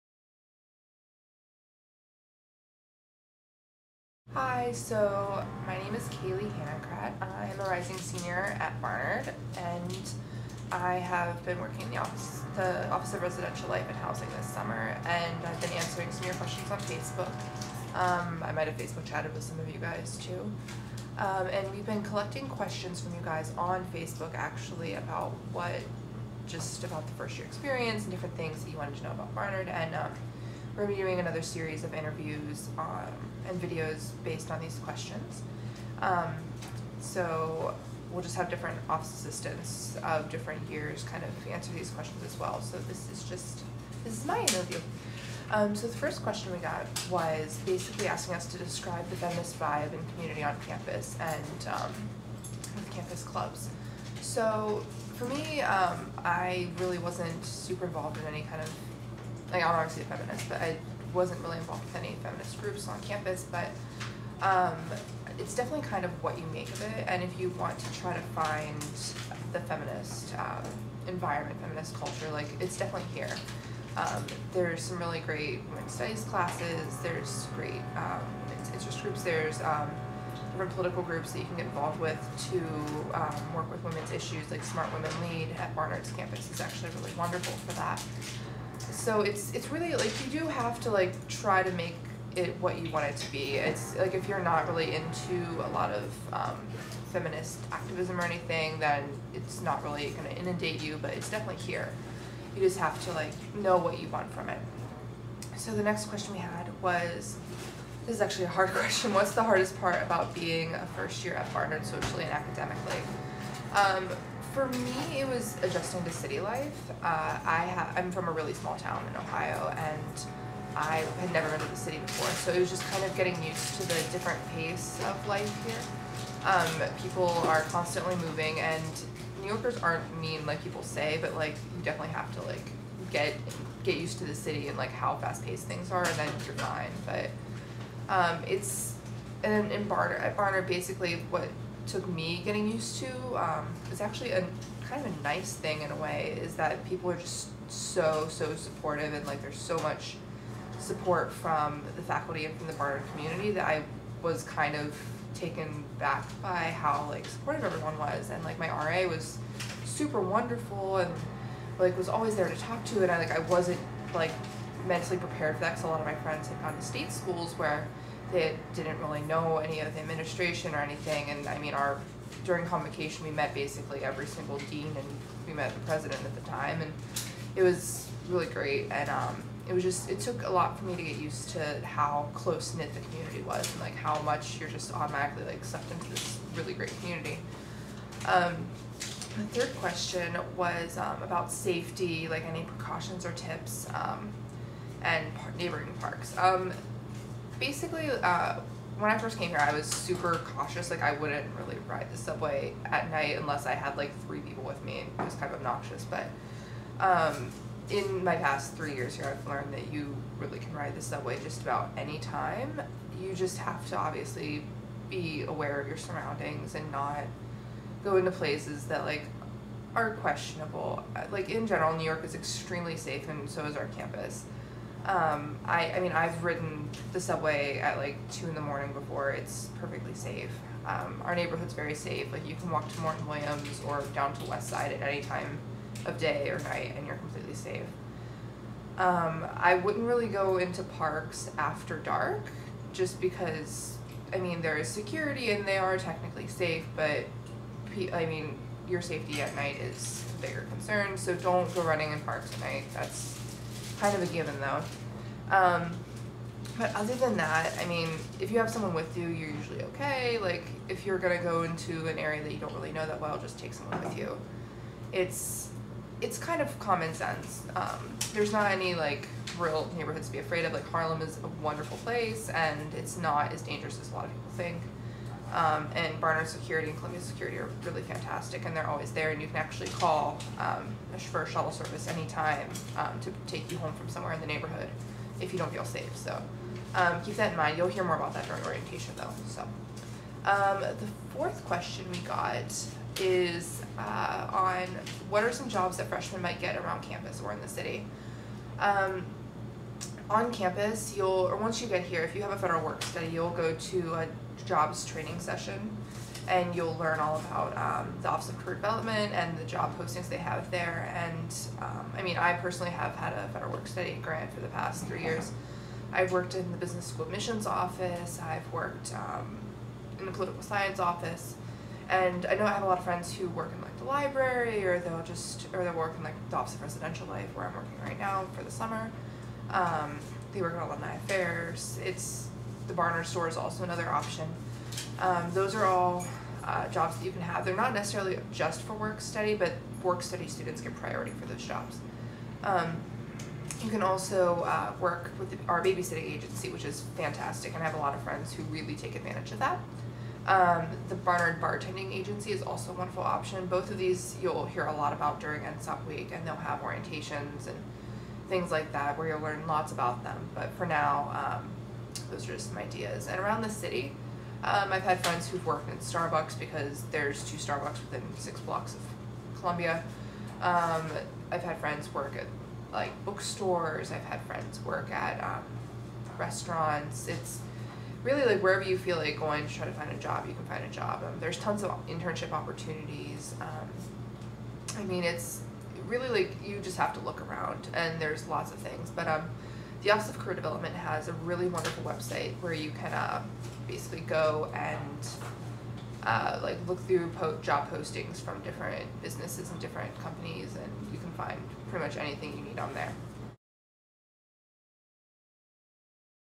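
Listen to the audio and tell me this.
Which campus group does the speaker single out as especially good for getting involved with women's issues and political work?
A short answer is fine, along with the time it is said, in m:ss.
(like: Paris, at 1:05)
Smart Women Lead, at 1:24.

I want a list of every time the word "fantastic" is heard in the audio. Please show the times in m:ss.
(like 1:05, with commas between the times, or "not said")
4:38, 5:47.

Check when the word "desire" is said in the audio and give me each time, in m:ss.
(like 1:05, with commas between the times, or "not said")
not said.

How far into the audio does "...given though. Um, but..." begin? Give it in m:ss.
4:14.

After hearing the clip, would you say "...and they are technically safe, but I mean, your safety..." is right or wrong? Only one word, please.
right.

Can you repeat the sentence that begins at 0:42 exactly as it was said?
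So this is just, this is my interview.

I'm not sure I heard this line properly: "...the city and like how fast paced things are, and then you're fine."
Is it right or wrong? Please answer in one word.
right.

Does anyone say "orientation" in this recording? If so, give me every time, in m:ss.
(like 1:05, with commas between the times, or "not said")
4:48, 5:56.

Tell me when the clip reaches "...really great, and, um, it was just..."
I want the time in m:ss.
2:58.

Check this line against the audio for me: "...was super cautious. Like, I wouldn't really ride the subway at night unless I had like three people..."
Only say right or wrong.
right.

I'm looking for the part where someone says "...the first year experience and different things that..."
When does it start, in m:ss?
0:27.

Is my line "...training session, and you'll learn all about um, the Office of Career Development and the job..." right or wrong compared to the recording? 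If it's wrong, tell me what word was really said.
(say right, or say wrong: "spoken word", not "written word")
right.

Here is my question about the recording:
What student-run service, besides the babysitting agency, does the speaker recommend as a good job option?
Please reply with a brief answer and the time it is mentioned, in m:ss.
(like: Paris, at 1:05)
Barnard Bartending Agency, at 5:51.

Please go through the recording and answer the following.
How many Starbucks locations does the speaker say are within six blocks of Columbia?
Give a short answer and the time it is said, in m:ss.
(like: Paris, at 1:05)
2, at 6:07.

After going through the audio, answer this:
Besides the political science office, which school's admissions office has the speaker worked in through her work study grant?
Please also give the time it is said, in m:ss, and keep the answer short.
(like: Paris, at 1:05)
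business school, at 5:16.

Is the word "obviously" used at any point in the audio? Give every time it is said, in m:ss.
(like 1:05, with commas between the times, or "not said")
0:59, 3:33.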